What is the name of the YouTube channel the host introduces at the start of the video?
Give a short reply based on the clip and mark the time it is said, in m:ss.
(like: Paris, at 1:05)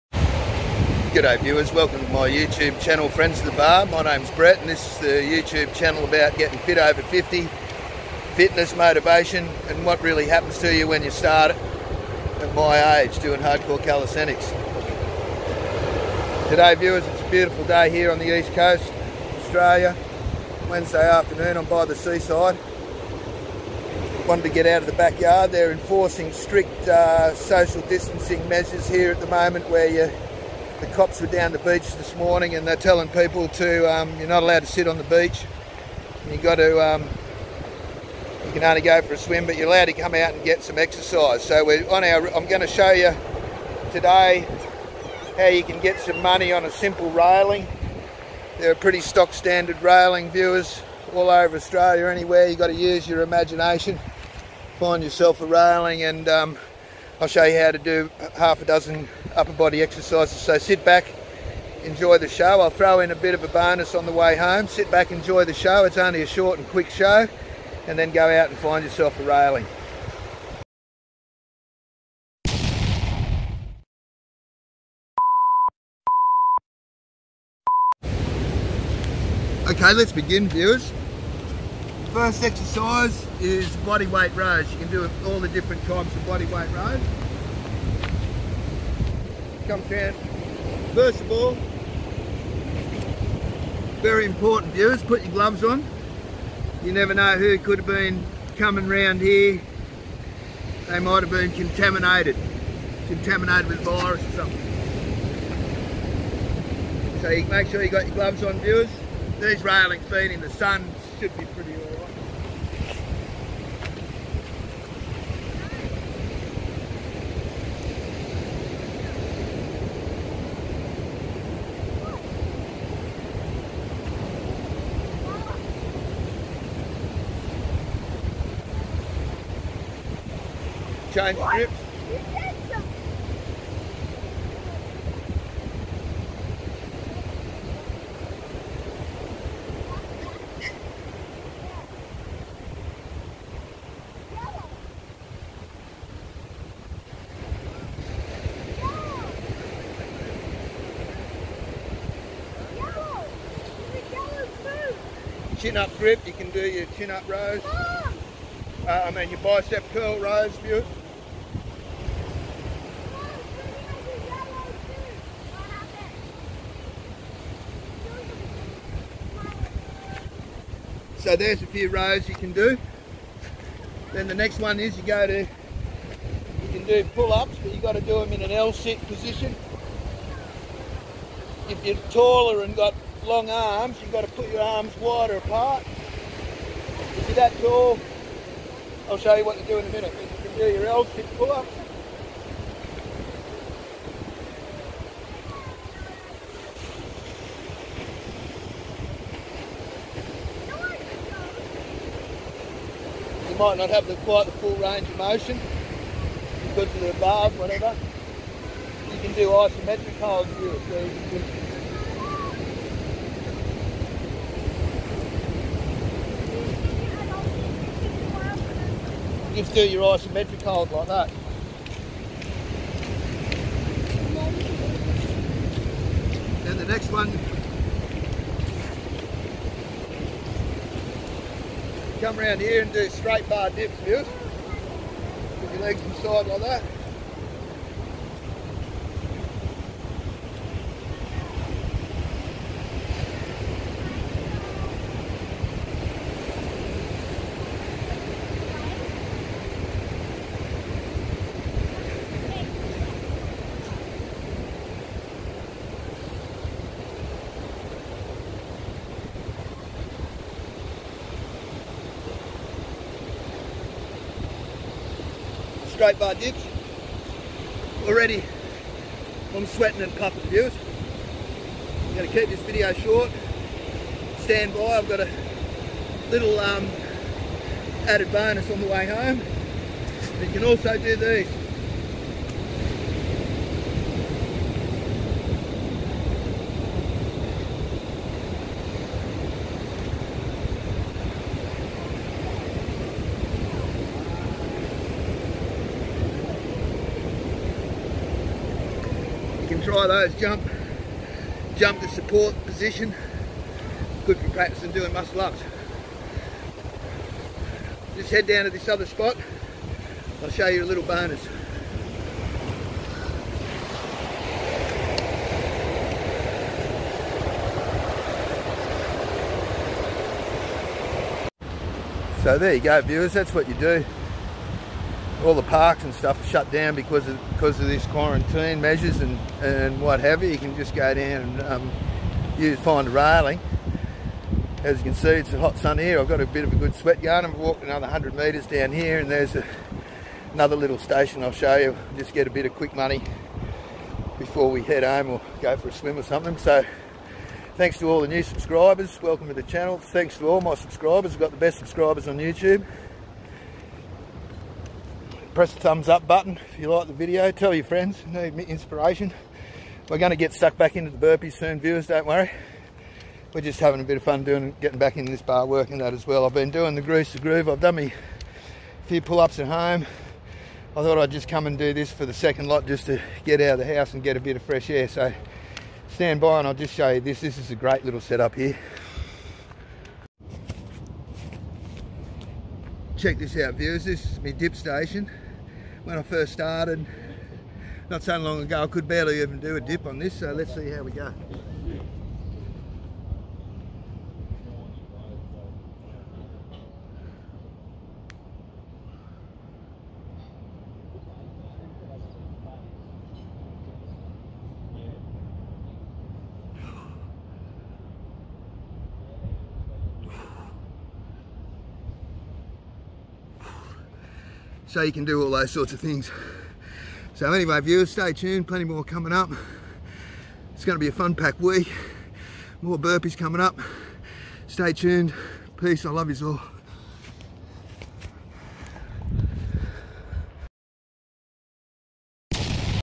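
Friends of the Bar, at 0:03.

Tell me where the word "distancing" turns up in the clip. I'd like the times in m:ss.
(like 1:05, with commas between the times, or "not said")
0:27.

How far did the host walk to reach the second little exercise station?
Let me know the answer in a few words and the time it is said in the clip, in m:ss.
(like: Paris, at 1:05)
100 metres, at 5:38.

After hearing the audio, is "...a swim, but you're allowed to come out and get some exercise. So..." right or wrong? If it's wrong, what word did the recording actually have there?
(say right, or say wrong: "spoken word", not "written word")
right.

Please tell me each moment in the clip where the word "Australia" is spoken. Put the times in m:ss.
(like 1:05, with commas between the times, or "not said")
0:19, 0:51.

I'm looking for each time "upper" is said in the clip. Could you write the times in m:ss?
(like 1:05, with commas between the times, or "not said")
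0:59.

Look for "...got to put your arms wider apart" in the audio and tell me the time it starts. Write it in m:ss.
3:04.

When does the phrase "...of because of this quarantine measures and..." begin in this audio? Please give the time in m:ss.
5:27.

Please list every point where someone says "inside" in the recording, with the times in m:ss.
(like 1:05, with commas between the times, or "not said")
3:56.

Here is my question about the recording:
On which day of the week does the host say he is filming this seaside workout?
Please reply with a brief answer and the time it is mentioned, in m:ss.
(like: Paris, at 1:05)
Wednesday, at 0:20.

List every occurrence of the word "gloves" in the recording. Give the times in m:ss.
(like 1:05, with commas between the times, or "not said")
1:35, 1:48.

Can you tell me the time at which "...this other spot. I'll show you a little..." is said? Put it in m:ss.
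5:08.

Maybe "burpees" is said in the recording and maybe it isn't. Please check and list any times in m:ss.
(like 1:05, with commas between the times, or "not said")
6:01, 7:02.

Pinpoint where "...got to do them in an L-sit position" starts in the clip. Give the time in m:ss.
2:57.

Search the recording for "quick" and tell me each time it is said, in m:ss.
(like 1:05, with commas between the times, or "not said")
1:06, 5:42.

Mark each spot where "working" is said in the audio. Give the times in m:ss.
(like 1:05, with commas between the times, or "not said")
6:05.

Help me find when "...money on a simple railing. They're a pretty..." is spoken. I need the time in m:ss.
0:46.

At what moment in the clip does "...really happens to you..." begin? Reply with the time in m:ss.
0:10.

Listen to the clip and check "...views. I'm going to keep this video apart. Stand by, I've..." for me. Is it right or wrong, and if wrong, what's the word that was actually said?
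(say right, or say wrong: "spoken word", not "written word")
wrong: "short", not "apart".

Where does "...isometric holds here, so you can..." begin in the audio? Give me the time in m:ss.
3:29.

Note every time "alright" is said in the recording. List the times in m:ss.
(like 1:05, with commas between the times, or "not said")
1:51.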